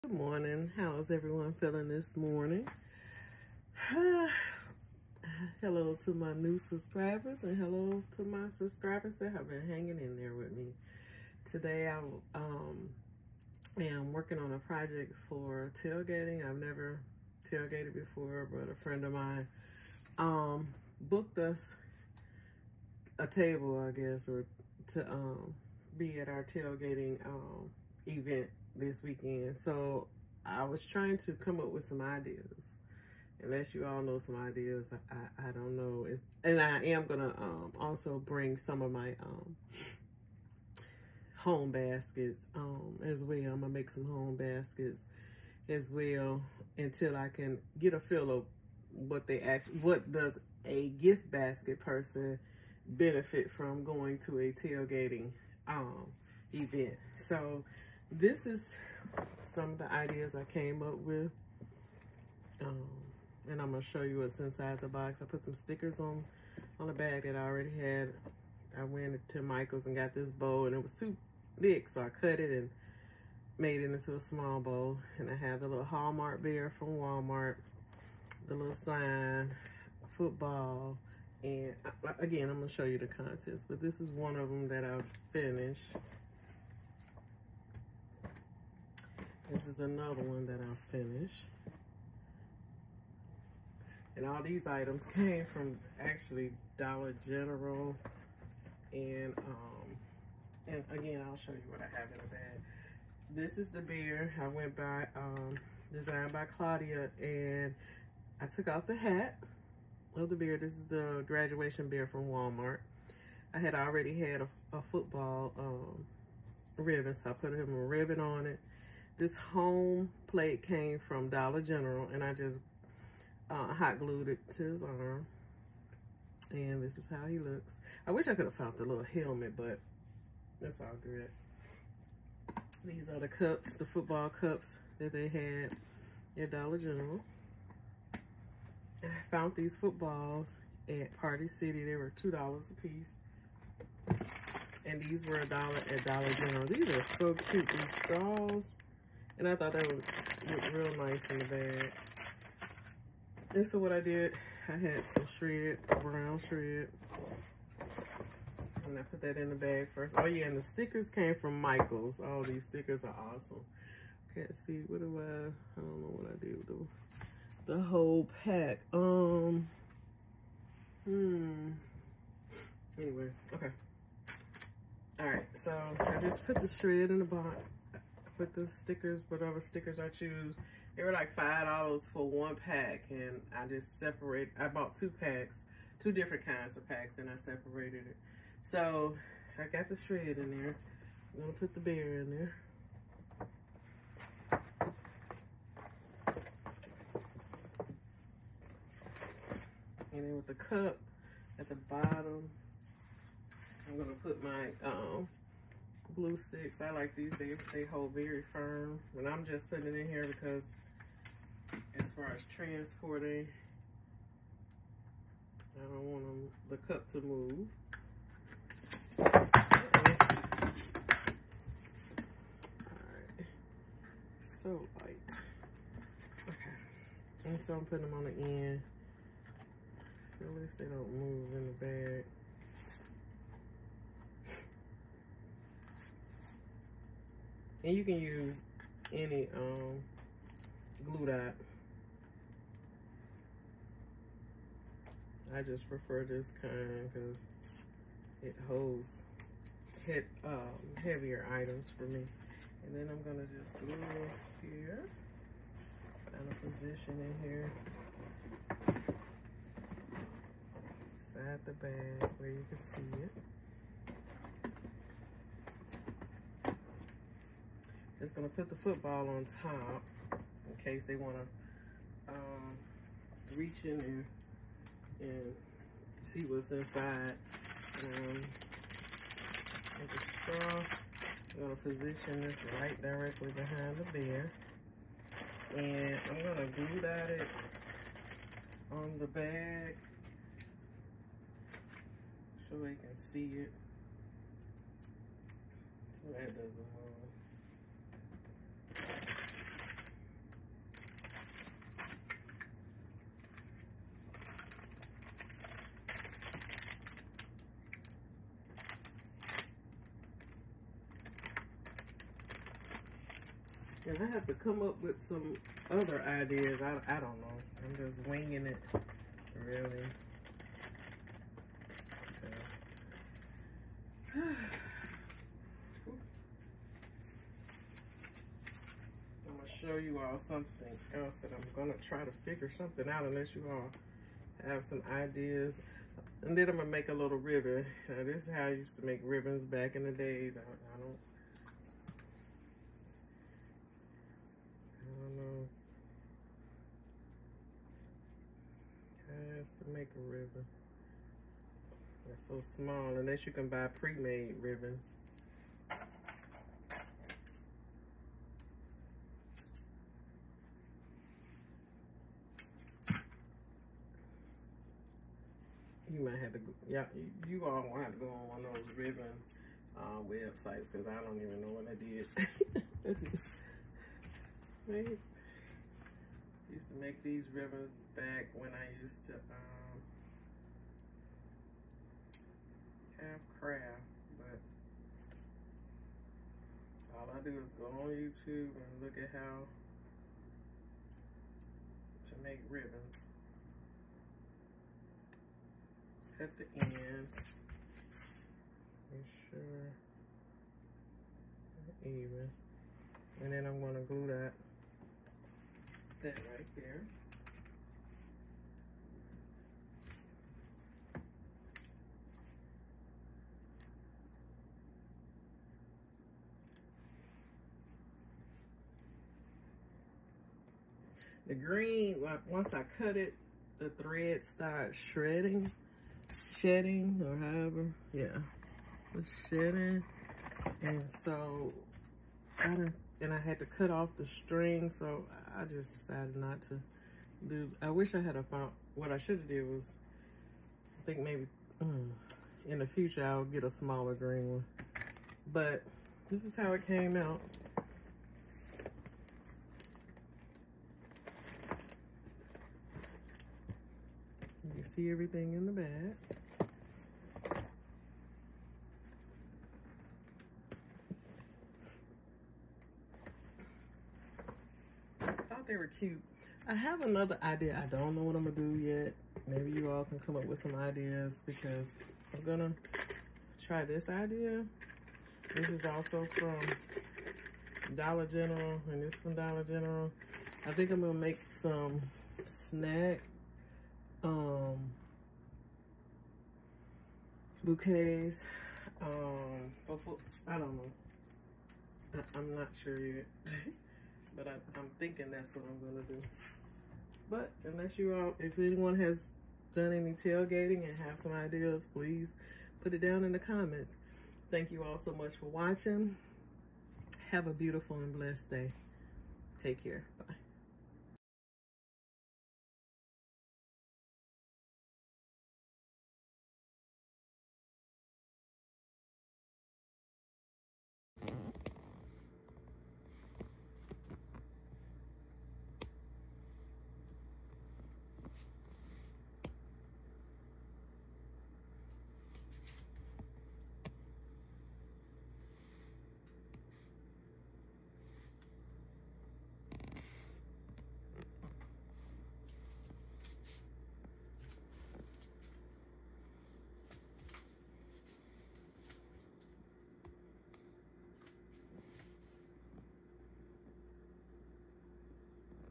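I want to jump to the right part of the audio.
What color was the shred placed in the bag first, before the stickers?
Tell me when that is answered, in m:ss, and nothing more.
2:36.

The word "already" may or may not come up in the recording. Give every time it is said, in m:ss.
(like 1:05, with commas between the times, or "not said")
1:07, 1:53.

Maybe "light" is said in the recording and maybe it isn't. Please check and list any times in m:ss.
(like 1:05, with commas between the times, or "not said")
3:45.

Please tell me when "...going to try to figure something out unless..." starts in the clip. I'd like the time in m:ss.
5:31.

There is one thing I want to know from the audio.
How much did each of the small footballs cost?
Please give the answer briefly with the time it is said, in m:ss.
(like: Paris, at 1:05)
$2, at 2:22.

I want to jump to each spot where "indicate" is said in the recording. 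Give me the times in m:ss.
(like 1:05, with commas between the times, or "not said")
not said.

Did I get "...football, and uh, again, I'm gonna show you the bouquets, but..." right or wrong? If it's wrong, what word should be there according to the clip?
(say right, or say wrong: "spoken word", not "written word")
wrong: "contents", not "bouquets".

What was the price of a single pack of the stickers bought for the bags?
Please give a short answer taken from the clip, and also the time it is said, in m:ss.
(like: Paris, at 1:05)
$5, at 3:01.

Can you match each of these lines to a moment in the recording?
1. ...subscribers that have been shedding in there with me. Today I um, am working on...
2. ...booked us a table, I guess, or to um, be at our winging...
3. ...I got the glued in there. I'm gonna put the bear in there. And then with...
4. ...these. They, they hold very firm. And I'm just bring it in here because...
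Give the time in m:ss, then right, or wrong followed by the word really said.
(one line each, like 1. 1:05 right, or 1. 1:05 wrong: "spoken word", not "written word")
1. 0:08 wrong: "hanging", not "shedding"
2. 0:20 wrong: "tailgating", not "winging"
3. 3:09 wrong: "shred", not "glued"
4. 3:27 wrong: "putting", not "bring".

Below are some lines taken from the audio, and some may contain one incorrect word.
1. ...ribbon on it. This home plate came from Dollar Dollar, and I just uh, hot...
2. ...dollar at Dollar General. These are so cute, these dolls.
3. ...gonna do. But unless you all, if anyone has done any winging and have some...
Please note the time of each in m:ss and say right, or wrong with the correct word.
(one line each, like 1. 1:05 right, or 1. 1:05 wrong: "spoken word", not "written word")
1. 1:57 wrong: "General", not "Dollar"
2. 2:25 right
3. 8:15 wrong: "tailgating", not "winging".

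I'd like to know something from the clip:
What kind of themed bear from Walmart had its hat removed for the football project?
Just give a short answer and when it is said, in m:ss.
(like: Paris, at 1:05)
graduation bear, at 1:51.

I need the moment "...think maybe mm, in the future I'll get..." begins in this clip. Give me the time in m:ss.
7:21.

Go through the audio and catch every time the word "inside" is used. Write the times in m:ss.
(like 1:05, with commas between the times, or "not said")
1:04, 4:36.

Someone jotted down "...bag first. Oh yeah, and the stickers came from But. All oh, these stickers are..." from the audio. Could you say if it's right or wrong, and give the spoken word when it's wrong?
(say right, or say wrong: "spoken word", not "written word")
wrong: "Michaels", not "But".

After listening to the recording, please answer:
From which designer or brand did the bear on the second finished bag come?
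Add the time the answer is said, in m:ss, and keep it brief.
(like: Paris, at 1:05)
Designs by Claudia, at 1:45.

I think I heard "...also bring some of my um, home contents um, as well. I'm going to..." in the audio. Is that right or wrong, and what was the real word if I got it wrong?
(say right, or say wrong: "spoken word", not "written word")
wrong: "baskets", not "contents".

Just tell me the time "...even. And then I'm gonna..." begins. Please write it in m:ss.
6:42.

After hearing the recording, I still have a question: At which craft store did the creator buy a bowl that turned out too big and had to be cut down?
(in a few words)
Michael's.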